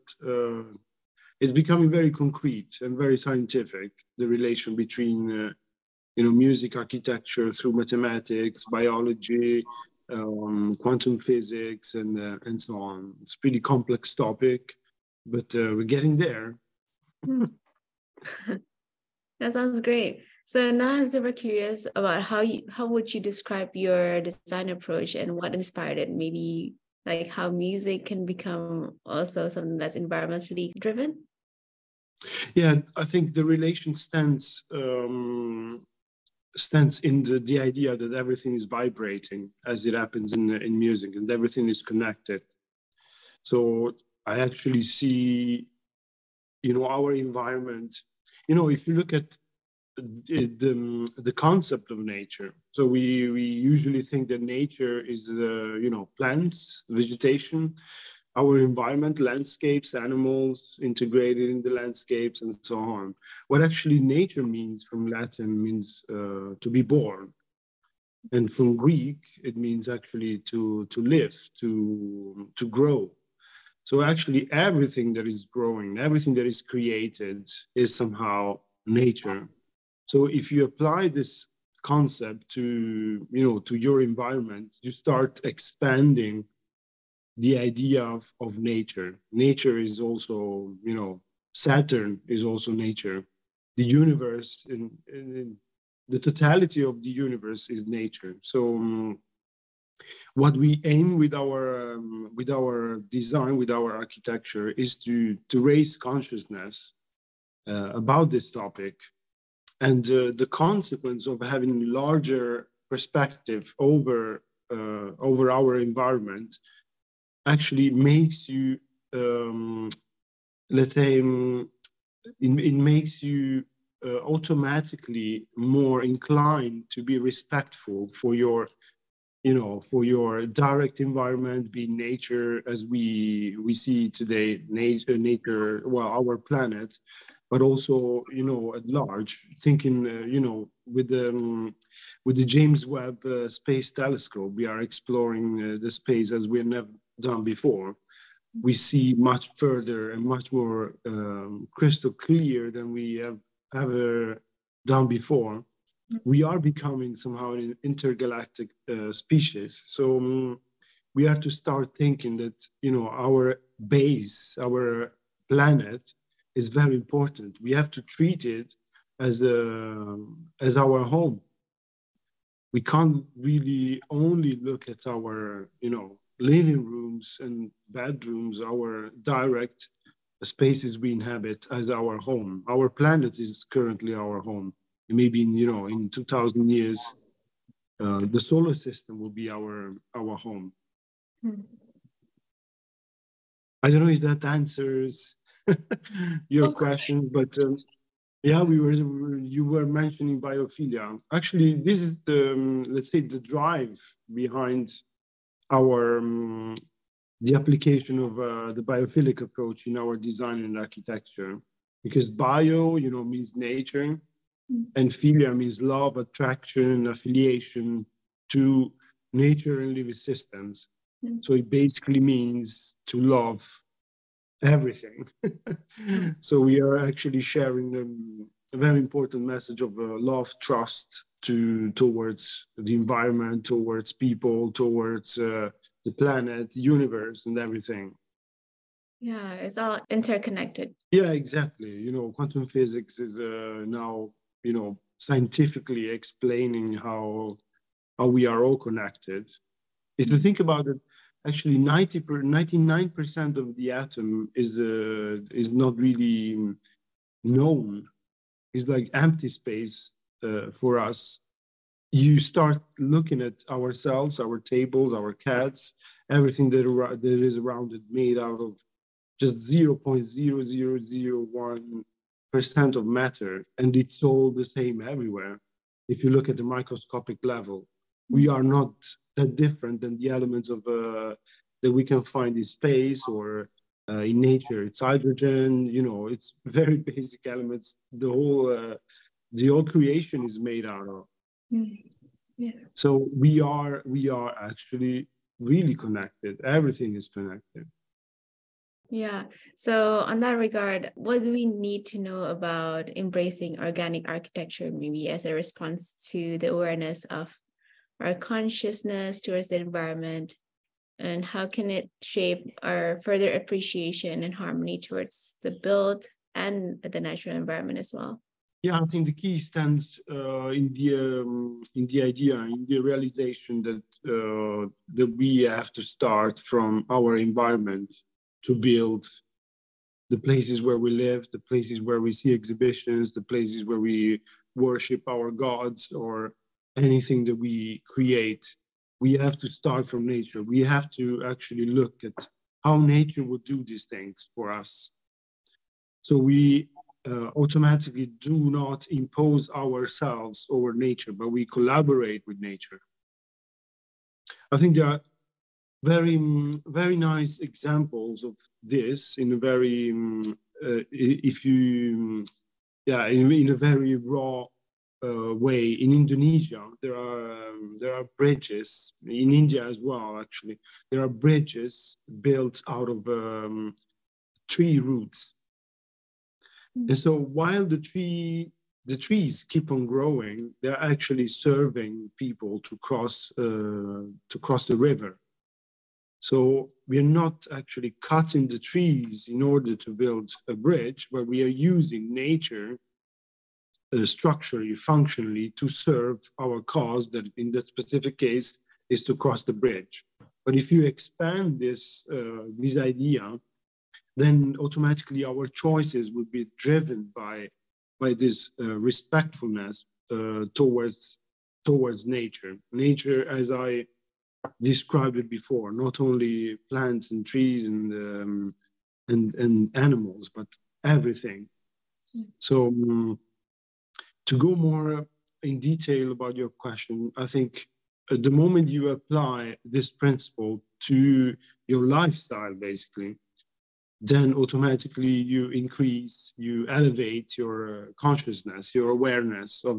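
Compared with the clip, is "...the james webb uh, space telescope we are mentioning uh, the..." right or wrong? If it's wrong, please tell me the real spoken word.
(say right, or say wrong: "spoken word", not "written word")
wrong: "exploring", not "mentioning".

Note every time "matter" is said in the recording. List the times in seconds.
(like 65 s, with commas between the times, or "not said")
273 s.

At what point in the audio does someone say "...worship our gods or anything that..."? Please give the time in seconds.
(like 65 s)
334 s.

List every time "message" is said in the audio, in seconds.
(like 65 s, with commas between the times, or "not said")
229 s.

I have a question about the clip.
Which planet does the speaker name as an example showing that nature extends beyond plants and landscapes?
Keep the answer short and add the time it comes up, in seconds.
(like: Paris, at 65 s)
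Saturn, at 91 s.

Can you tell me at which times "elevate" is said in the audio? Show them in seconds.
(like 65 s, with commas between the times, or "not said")
436 s.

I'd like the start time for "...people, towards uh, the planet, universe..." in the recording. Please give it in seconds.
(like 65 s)
234 s.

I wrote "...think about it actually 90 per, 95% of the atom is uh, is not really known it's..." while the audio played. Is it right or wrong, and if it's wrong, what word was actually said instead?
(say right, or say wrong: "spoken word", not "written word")
wrong: "99", not "95".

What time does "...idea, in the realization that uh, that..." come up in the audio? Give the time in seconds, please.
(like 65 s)
322 s.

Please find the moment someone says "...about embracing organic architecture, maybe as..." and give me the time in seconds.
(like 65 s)
302 s.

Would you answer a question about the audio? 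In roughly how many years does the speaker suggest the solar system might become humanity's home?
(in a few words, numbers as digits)
2000.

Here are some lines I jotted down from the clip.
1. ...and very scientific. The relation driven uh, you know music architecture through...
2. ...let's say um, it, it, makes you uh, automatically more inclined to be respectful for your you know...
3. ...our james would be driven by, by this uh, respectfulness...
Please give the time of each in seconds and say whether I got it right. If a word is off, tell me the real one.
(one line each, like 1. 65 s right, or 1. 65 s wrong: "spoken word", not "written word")
1. 2 s wrong: "between", not "driven"
2. 120 s right
3. 405 s wrong: "choices", not "james".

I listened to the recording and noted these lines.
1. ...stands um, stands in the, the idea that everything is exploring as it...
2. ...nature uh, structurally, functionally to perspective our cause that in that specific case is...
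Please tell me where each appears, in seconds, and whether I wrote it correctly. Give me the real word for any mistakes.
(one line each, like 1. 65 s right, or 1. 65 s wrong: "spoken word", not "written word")
1. 33 s wrong: "vibrating", not "exploring"
2. 392 s wrong: "serve", not "perspective".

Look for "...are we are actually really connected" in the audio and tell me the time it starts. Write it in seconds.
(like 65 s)
293 s.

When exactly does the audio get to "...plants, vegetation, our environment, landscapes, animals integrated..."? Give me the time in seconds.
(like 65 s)
56 s.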